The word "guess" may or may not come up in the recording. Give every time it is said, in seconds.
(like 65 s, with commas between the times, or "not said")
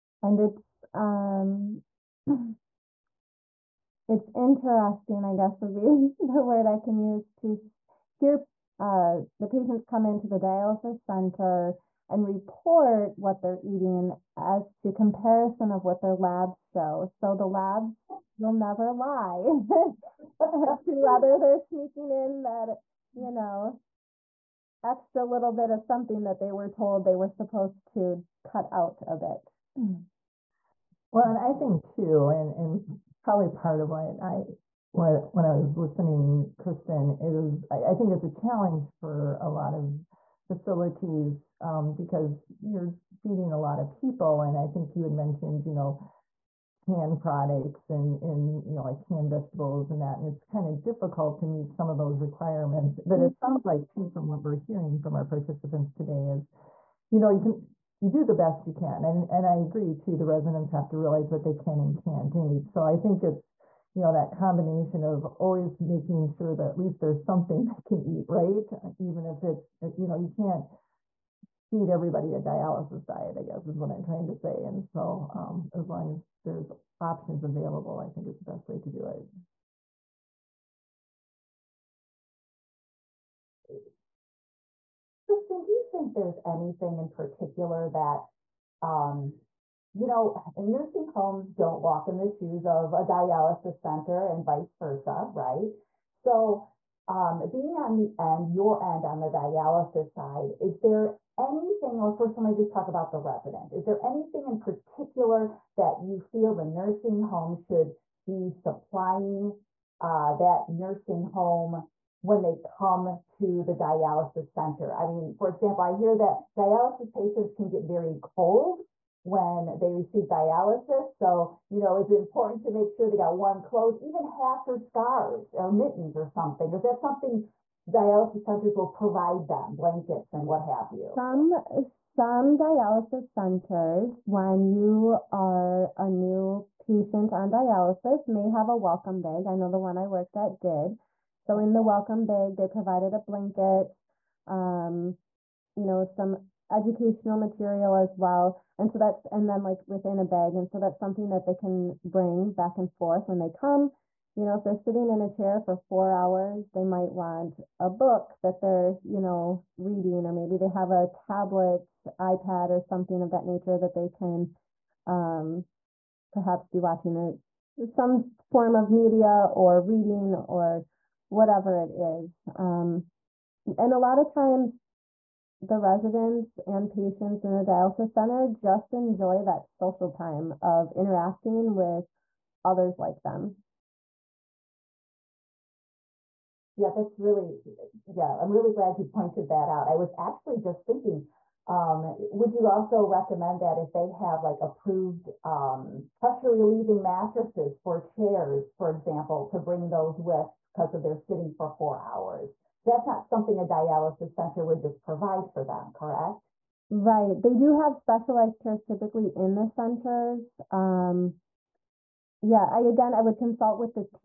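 5 s, 73 s.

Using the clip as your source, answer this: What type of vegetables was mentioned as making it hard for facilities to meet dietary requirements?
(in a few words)
canned vegetables.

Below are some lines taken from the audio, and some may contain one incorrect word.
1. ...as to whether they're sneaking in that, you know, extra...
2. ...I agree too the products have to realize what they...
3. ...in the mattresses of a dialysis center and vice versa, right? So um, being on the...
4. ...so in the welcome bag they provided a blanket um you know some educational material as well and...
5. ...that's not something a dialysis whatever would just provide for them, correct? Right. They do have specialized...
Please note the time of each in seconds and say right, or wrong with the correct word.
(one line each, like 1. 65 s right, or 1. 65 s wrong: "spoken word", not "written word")
1. 20 s right
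2. 59 s wrong: "residents", not "products"
3. 92 s wrong: "shoes", not "mattresses"
4. 141 s right
5. 202 s wrong: "center", not "whatever".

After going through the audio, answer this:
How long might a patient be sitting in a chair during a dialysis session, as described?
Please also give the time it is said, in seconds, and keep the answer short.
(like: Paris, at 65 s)
4 hours, at 155 s.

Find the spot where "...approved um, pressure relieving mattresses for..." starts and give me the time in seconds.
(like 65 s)
194 s.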